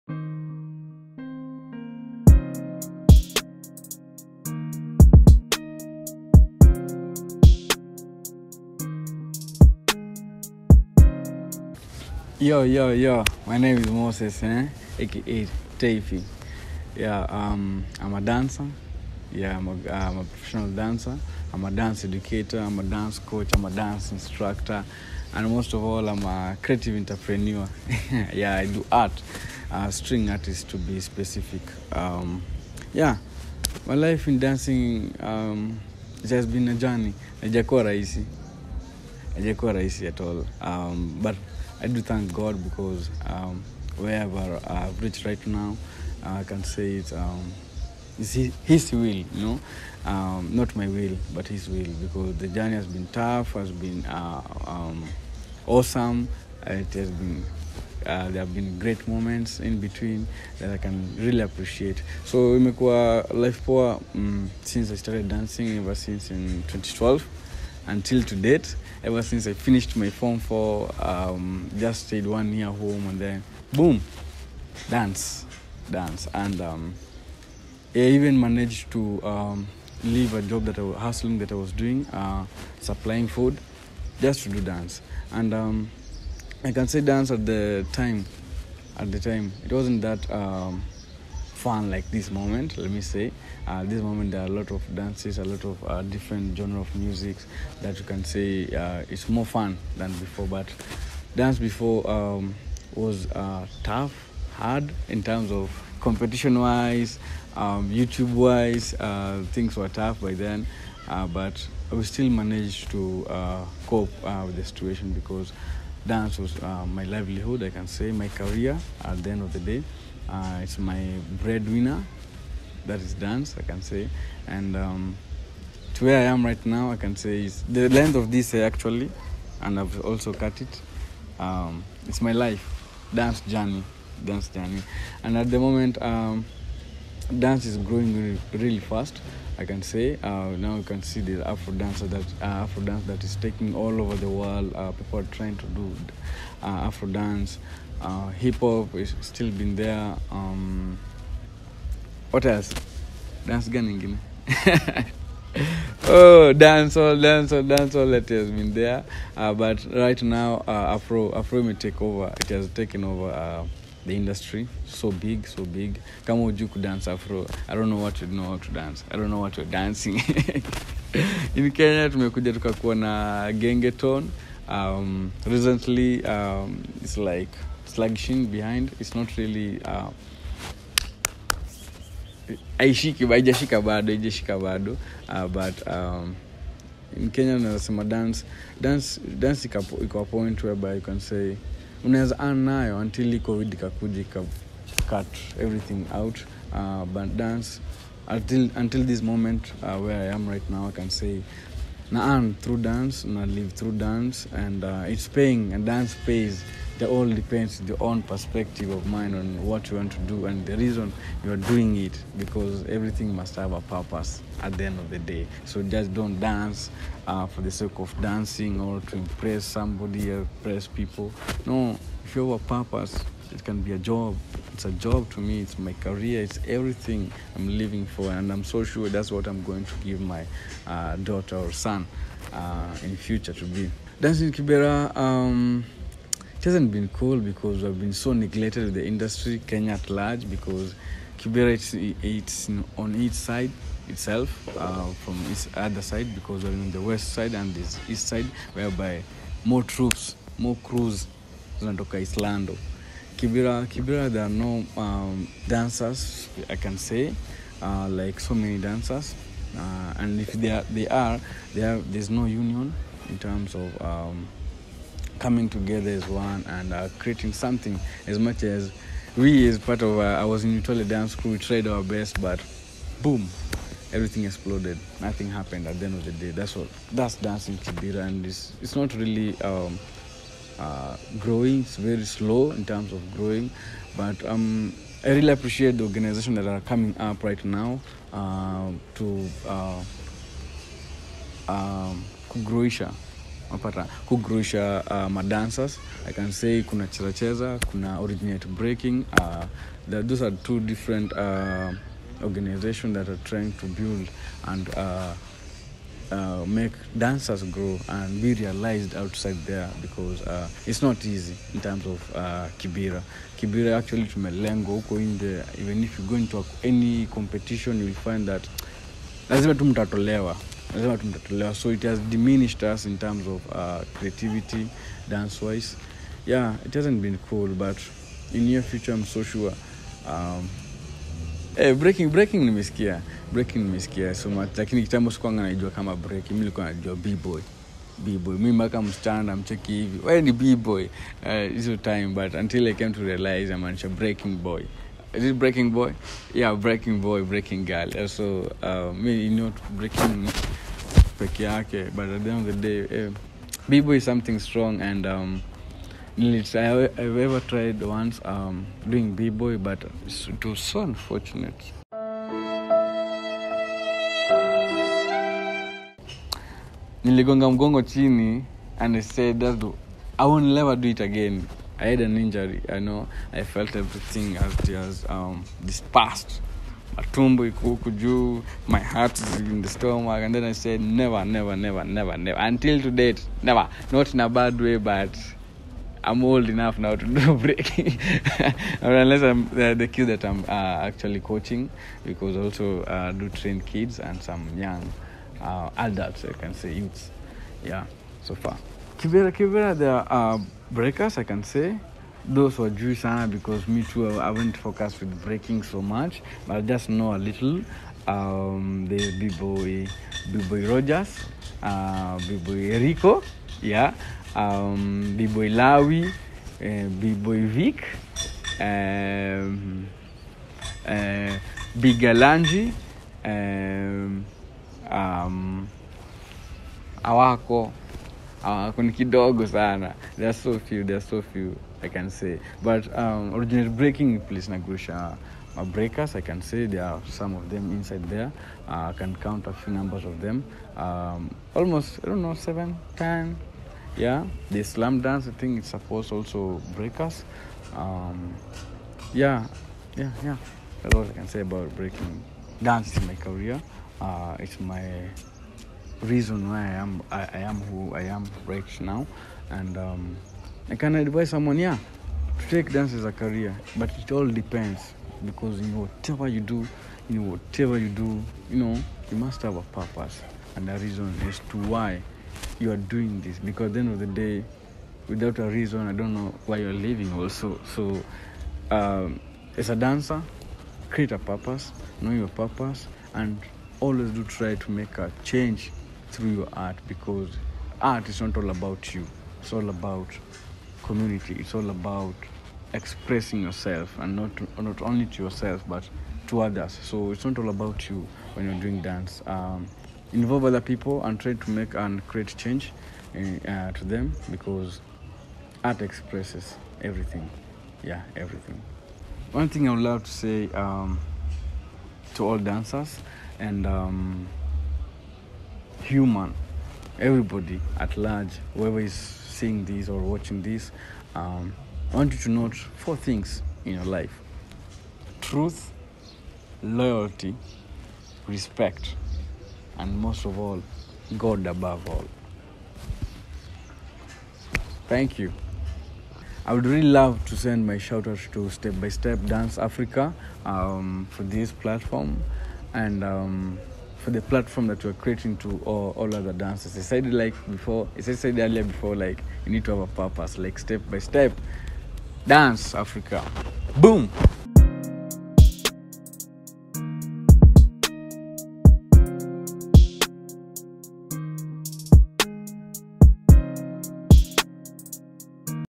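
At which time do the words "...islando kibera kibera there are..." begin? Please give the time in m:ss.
4:12.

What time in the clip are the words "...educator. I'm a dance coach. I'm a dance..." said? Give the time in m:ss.
0:22.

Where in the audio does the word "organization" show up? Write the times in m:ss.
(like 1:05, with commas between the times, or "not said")
4:46, 5:02.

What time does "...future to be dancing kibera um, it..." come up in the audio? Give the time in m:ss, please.
3:53.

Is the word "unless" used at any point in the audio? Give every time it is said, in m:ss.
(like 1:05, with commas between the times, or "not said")
6:29.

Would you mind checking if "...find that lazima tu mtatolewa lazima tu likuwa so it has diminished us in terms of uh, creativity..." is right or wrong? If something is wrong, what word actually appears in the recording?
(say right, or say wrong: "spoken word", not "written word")
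wrong: "mtatolewa", not "likuwa".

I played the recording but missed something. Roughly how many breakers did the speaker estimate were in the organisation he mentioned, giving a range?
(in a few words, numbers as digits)
7 to 10.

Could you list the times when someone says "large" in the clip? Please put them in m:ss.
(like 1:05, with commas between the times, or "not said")
4:00, 8:38.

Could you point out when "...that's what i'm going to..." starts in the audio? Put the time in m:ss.
3:49.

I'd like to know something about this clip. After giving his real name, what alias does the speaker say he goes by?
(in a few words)
Tafy.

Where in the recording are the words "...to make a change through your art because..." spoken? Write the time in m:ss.
8:04.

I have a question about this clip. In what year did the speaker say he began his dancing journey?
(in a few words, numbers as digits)
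2012.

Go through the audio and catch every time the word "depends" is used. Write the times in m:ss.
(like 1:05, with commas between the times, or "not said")
3:27, 7:44.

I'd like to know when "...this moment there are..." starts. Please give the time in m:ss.
1:33.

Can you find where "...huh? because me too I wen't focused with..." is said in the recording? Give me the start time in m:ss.
6:43.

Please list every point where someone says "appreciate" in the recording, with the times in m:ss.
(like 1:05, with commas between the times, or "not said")
1:01, 4:45.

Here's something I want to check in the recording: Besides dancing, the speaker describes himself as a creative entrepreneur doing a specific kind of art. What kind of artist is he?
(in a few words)
String artist.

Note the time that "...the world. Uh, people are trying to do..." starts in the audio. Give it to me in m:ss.
2:24.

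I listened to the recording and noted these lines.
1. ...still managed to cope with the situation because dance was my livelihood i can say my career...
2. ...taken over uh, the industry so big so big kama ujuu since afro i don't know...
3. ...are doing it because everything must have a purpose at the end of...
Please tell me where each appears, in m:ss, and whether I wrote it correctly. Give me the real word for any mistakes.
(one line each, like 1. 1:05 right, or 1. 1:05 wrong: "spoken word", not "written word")
1. 1:52 right
2. 2:42 wrong: "dance", not "since"
3. 3:31 right.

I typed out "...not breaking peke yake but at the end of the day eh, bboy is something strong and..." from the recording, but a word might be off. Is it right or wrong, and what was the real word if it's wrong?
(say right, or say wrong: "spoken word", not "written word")
right.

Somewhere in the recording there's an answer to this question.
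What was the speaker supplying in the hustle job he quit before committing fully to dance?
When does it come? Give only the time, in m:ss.
1:22.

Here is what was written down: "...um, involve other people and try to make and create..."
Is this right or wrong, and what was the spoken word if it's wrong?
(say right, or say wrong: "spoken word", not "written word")
right.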